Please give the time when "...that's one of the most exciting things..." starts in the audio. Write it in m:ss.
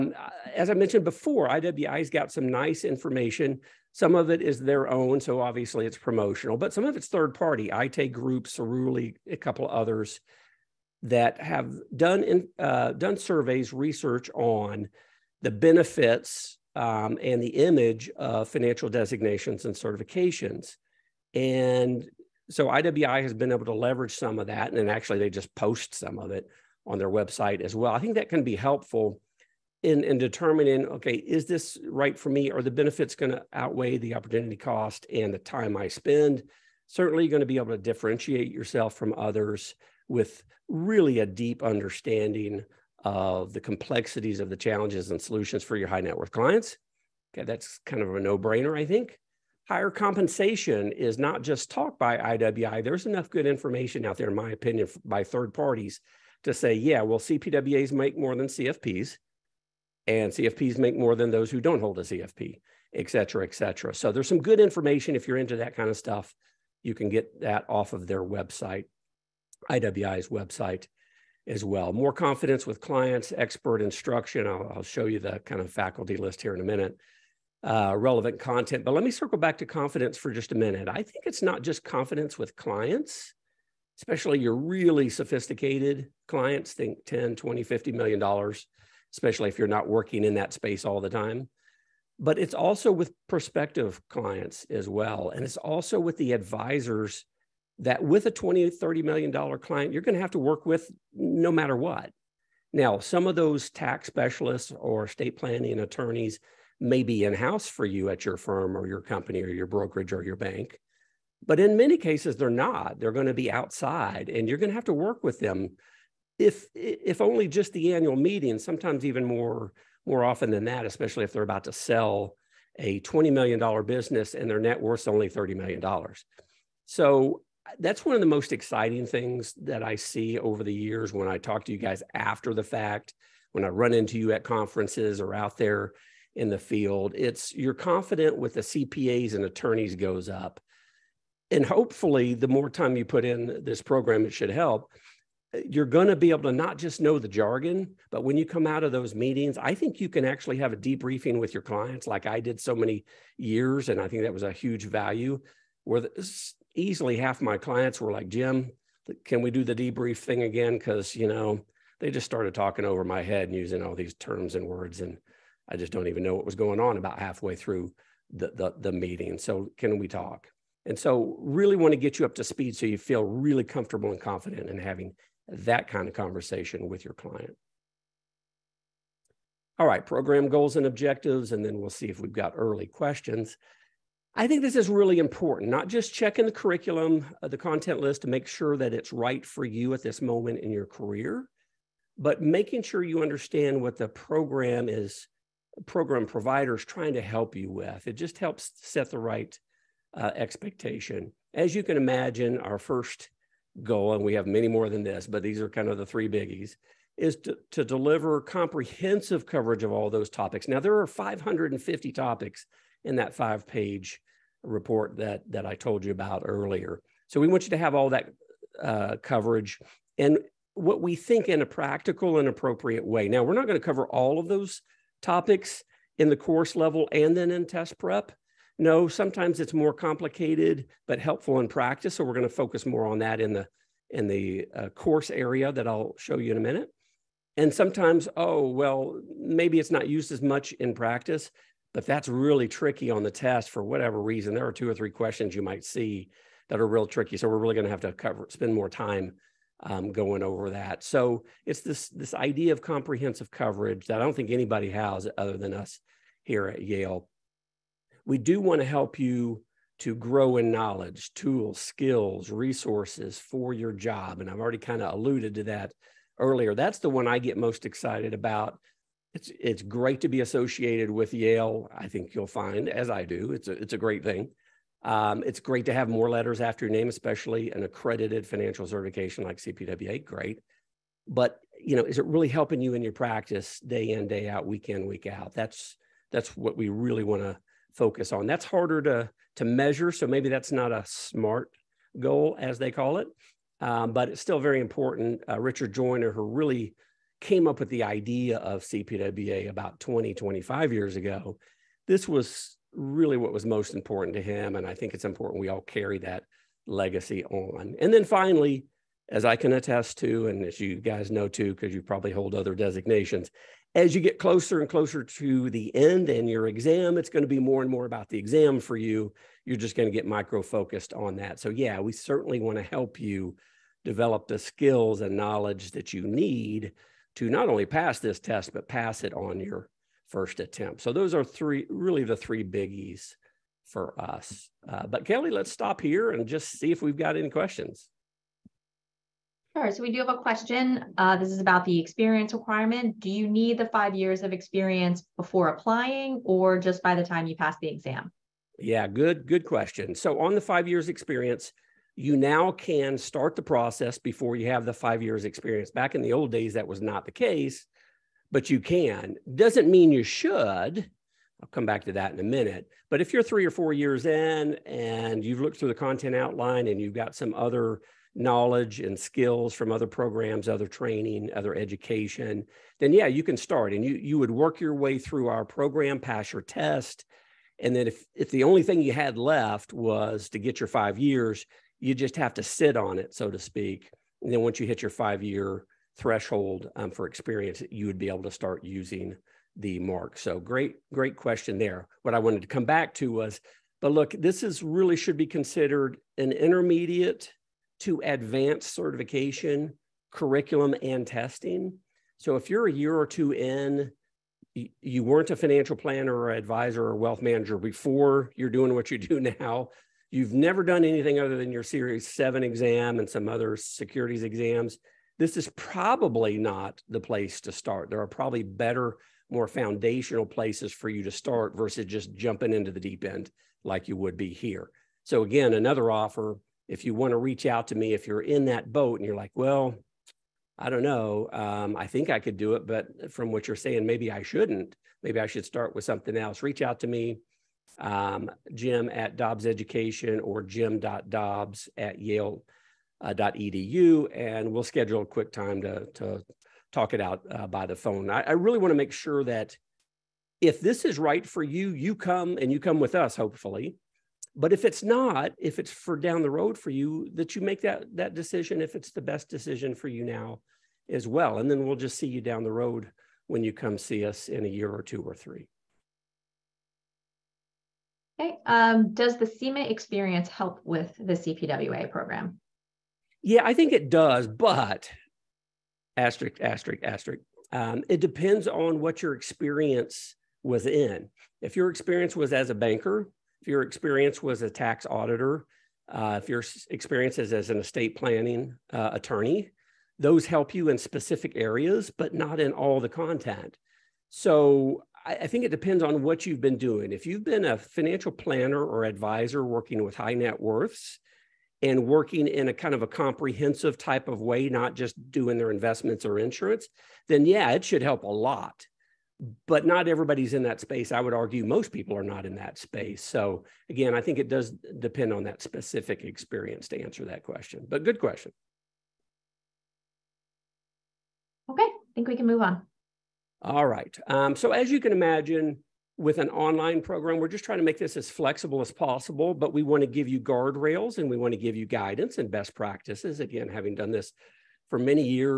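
2:07.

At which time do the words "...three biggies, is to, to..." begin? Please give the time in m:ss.
3:26.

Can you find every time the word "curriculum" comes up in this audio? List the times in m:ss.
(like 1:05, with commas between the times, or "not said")
3:06, 6:40.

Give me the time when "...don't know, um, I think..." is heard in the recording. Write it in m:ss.
7:10.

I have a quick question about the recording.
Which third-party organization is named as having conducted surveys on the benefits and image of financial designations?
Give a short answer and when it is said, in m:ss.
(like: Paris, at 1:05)
ITA Group, at 0:07.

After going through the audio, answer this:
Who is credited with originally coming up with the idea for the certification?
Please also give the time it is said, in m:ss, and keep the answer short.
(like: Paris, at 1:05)
Richard Joyner, at 4:55.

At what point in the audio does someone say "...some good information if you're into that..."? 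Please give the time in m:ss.
1:04.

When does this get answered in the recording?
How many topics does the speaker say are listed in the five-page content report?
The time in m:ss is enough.
3:31.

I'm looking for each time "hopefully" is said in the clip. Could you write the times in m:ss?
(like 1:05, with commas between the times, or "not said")
2:21, 7:33.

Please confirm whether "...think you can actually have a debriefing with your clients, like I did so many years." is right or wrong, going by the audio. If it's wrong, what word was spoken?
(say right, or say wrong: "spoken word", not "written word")
right.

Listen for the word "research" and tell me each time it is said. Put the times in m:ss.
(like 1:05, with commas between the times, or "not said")
0:13.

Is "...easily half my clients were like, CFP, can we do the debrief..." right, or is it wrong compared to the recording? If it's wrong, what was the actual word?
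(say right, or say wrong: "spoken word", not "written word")
wrong: "Jim", not "CFP".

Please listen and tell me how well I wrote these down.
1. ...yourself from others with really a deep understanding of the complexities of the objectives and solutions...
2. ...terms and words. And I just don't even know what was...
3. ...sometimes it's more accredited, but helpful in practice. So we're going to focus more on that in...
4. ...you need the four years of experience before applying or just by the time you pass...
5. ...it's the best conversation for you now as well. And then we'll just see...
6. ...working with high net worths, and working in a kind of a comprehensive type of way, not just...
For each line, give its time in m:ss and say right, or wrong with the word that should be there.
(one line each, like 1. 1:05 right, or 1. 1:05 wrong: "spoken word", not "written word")
1. 0:38 wrong: "challenges", not "objectives"
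2. 2:44 right
3. 3:49 wrong: "complicated", not "accredited"
4. 5:43 wrong: "five", not "four"
5. 7:38 wrong: "decision", not "conversation"
6. 8:19 right.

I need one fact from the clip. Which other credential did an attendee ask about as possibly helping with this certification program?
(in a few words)
CIMA.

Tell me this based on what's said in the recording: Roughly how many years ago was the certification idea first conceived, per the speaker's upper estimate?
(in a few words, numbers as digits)
25 years.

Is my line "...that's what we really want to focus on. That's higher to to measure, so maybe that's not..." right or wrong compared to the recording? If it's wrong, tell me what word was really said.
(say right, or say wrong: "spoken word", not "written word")
wrong: "harder", not "higher".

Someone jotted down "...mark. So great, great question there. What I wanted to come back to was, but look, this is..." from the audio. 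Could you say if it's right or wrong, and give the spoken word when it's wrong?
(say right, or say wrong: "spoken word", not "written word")
right.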